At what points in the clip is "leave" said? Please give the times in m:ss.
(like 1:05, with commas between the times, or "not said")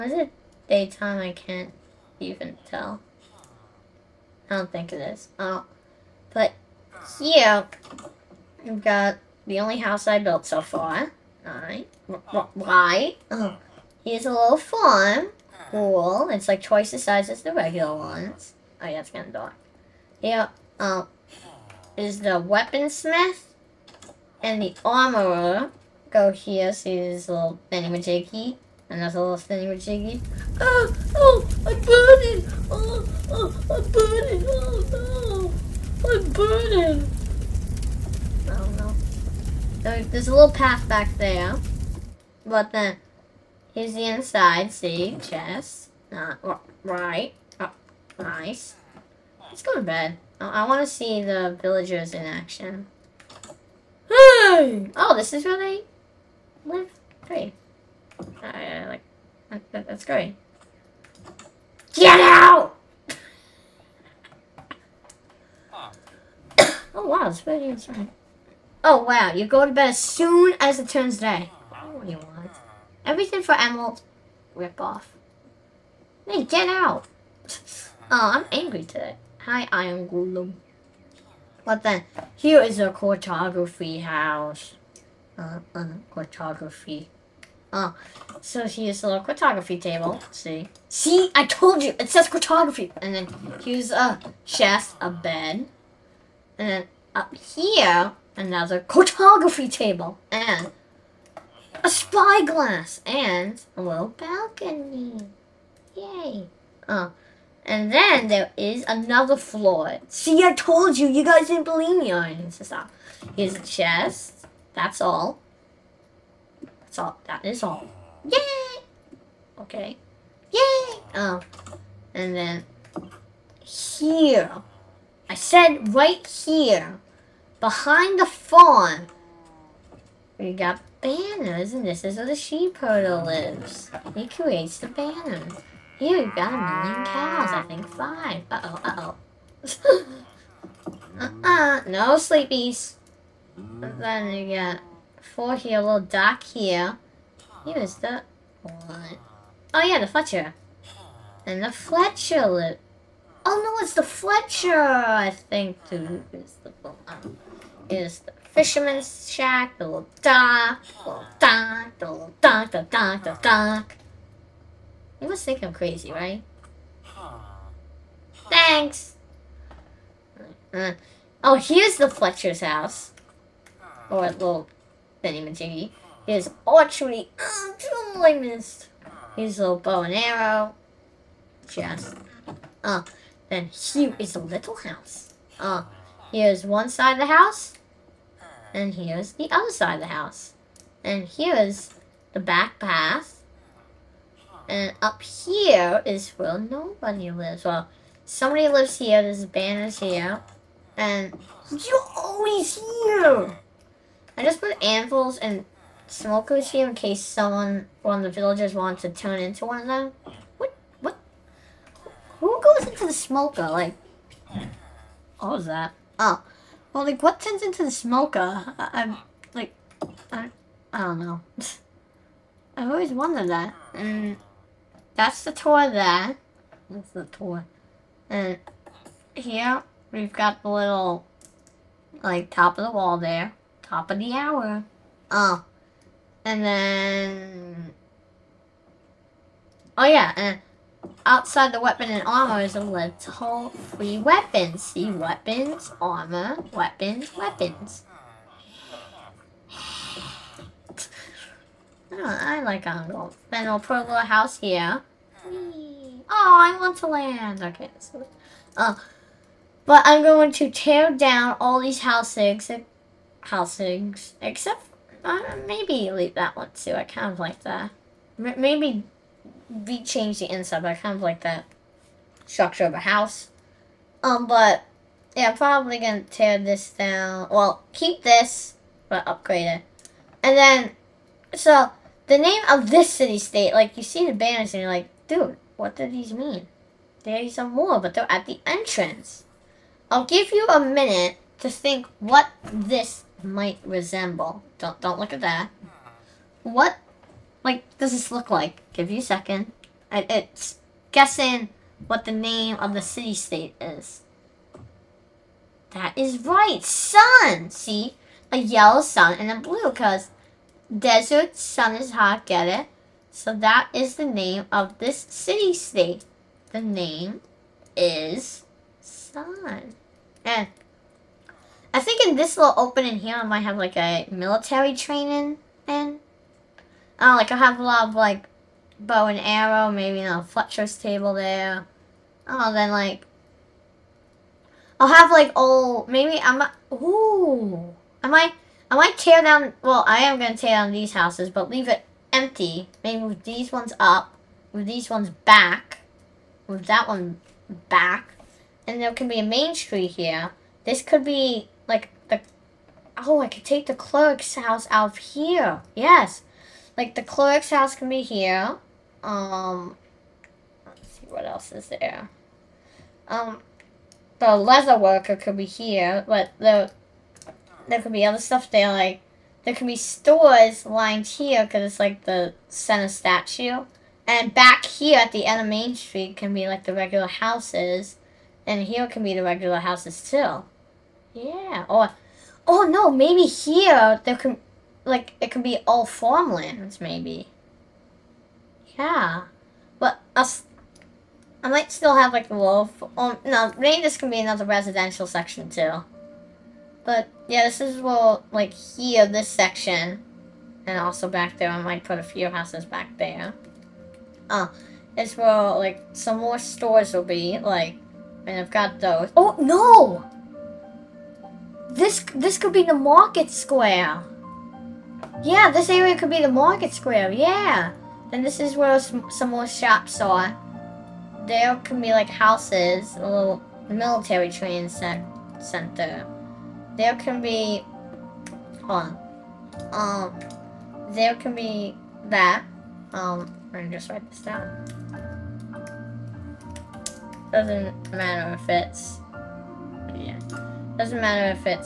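4:26, 5:41.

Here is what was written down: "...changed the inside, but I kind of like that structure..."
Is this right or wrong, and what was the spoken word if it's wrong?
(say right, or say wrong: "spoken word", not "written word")
right.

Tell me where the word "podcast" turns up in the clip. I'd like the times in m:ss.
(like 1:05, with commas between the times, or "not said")
not said.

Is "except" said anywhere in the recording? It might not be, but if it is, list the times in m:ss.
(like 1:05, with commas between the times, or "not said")
4:24.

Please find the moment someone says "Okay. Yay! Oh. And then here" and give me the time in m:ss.
1:59.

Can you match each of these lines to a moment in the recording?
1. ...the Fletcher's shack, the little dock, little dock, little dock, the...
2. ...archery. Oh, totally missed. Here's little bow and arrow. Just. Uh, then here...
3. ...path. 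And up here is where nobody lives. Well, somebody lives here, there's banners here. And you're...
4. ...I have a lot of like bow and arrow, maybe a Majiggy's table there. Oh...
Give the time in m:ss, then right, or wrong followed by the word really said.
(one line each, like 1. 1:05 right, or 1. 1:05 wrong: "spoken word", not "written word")
1. 2:37 wrong: "Fisherman", not "Fletcher"
2. 2:56 right
3. 3:12 right
4. 5:27 wrong: "Fletcher", not "Majiggy".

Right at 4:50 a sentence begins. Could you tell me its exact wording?
I'll give you a minute to think what this might resemble.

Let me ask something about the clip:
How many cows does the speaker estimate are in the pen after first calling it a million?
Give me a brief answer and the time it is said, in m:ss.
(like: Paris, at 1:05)
5, at 2:17.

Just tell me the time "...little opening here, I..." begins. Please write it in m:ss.
5:22.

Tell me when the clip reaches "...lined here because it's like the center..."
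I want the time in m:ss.
6:10.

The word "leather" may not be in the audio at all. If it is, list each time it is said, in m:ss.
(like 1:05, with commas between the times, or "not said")
6:04.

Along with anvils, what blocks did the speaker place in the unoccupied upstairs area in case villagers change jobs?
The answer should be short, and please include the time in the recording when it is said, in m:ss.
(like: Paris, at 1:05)
Smokers, at 3:26.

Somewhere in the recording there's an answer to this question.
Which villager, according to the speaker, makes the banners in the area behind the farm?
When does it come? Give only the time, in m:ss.
2:12.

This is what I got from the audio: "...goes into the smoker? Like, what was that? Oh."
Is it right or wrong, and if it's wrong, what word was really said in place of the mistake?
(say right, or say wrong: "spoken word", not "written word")
right.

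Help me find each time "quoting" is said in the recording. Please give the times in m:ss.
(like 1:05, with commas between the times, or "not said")
not said.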